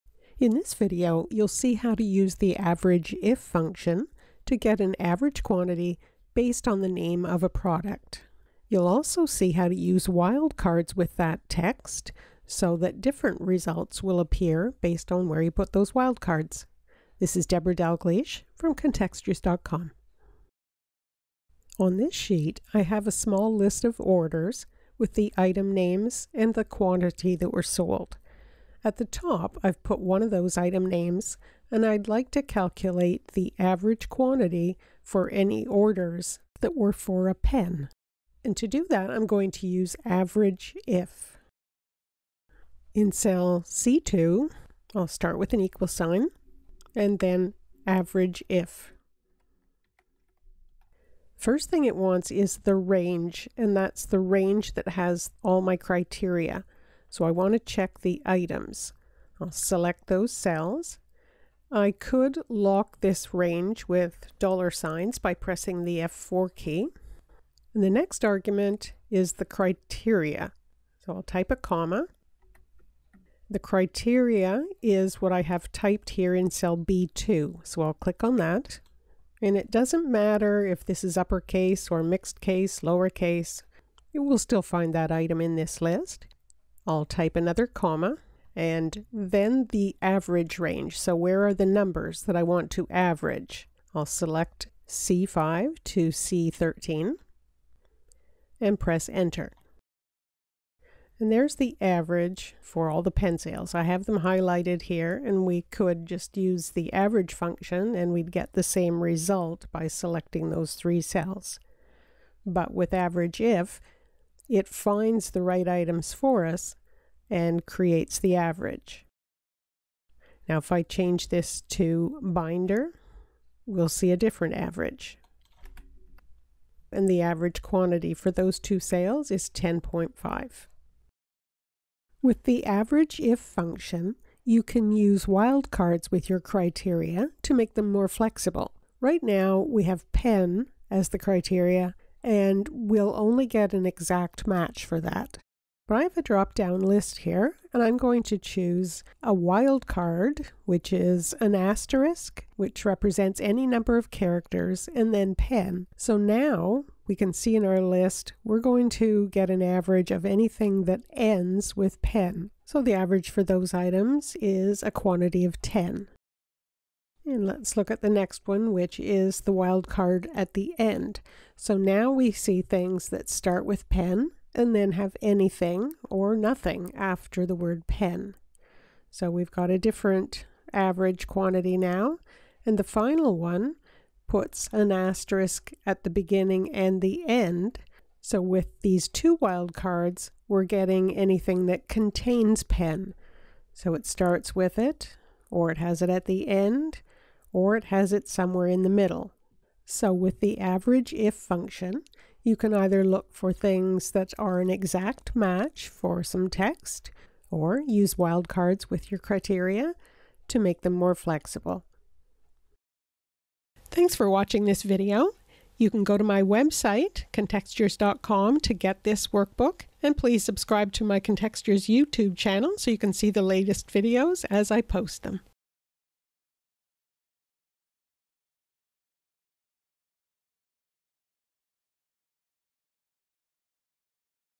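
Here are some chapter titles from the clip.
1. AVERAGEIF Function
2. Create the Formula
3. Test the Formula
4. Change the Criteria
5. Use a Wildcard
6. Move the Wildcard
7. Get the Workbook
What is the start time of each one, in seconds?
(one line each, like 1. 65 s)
1. 20 s
2. 41 s
3. 99 s
4. 119 s
5. 131 s
6. 166 s
7. 212 s.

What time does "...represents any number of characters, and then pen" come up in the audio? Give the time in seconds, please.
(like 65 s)
152 s.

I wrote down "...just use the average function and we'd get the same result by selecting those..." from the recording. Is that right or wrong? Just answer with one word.
right.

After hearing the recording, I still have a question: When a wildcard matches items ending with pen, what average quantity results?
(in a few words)
10.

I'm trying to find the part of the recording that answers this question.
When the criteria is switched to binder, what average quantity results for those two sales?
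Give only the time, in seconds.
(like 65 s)
129 s.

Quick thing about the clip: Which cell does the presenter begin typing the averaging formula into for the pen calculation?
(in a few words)
C2.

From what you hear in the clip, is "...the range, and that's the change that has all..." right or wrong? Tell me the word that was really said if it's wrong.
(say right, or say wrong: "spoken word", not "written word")
wrong: "range", not "change".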